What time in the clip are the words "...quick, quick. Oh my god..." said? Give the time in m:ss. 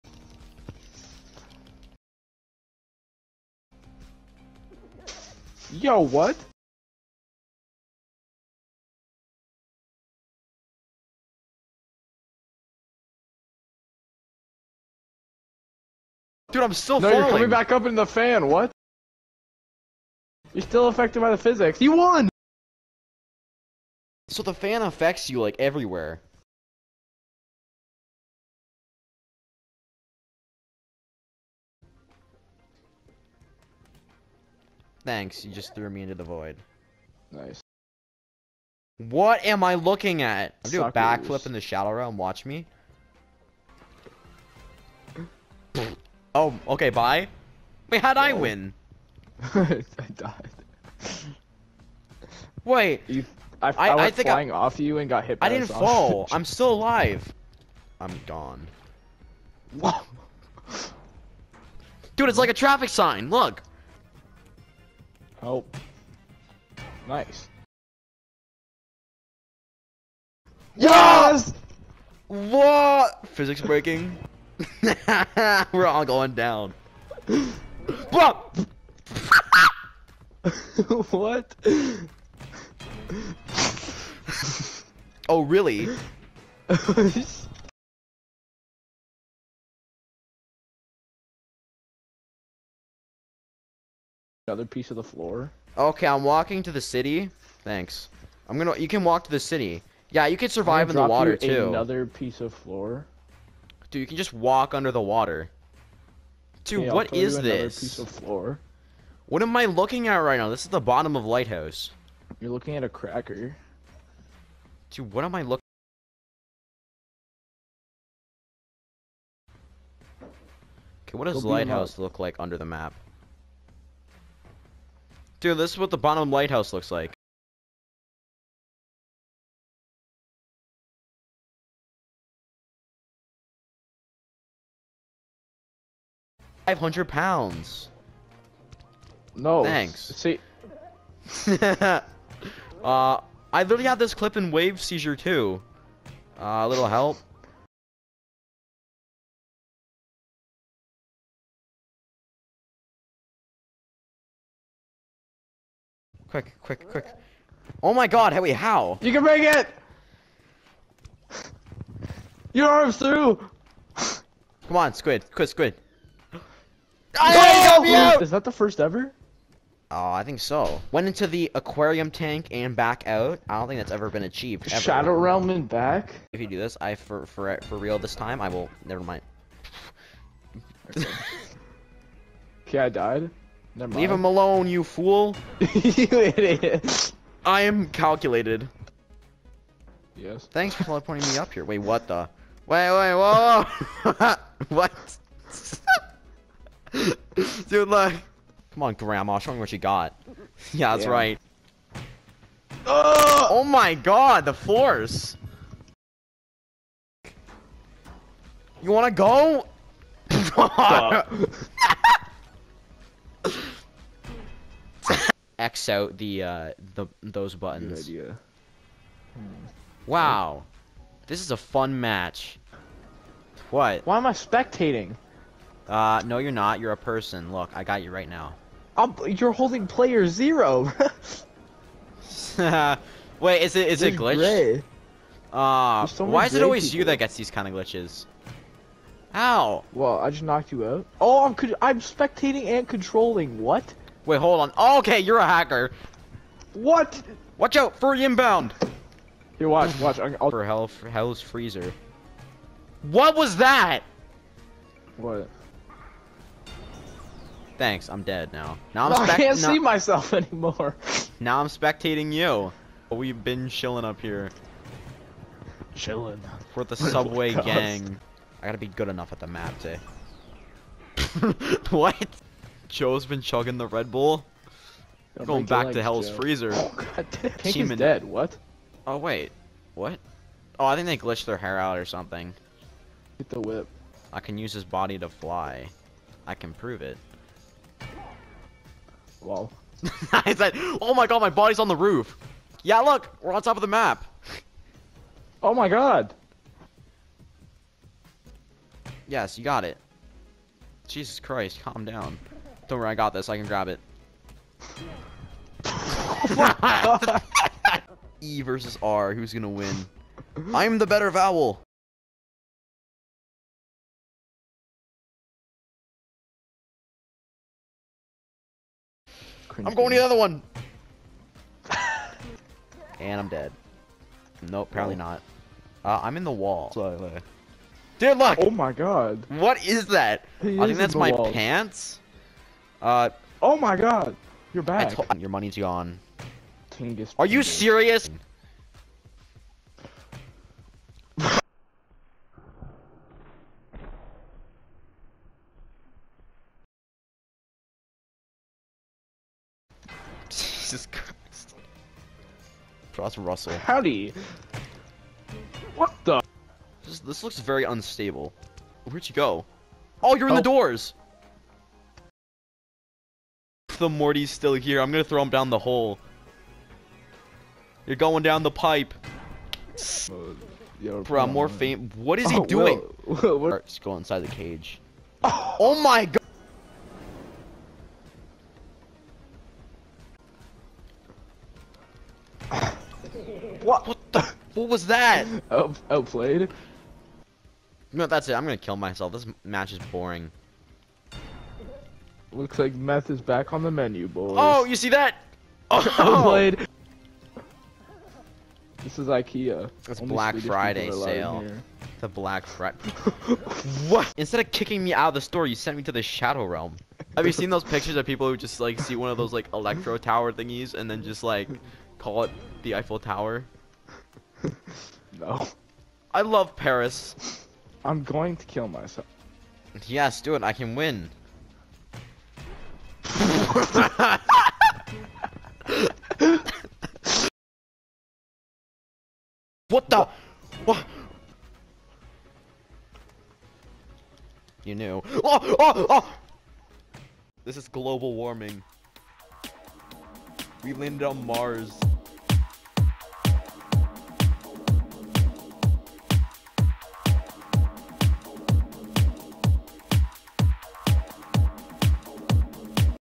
2:36.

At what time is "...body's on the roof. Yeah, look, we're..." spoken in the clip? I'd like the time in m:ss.
4:51.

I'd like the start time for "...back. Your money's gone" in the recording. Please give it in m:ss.
5:34.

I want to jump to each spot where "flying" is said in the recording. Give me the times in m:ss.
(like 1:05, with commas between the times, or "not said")
0:54.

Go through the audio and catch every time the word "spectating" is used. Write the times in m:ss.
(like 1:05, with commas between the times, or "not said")
3:44, 4:02, 4:21.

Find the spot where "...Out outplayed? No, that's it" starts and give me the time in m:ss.
6:25.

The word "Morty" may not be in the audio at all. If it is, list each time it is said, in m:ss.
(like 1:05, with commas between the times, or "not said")
6:04.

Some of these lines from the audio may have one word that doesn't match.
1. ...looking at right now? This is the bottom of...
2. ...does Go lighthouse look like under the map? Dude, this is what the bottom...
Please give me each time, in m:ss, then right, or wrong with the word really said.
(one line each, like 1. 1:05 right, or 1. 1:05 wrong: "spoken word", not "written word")
1. 1:49 right
2. 2:01 right.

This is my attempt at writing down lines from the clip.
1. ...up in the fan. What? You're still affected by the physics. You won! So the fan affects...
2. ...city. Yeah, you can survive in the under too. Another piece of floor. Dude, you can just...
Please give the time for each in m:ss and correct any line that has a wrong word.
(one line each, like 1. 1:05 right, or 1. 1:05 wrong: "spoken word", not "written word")
1. 0:17 right
2. 1:39 wrong: "water", not "under".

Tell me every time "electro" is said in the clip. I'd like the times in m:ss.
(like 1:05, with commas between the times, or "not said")
6:49.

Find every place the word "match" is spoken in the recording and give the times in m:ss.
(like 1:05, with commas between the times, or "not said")
3:42, 6:29.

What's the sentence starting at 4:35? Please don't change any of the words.
Don't Going back to Hell's Joe.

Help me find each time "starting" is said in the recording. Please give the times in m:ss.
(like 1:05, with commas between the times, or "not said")
not said.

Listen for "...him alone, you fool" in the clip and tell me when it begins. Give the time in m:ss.
3:04.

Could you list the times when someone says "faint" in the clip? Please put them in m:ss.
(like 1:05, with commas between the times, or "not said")
6:11.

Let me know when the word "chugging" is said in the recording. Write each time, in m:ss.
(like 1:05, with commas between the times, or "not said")
4:33.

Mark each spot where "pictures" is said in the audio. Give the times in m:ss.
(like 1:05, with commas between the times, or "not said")
6:47.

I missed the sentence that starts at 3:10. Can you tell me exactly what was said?
Thanks for teleporting me up here.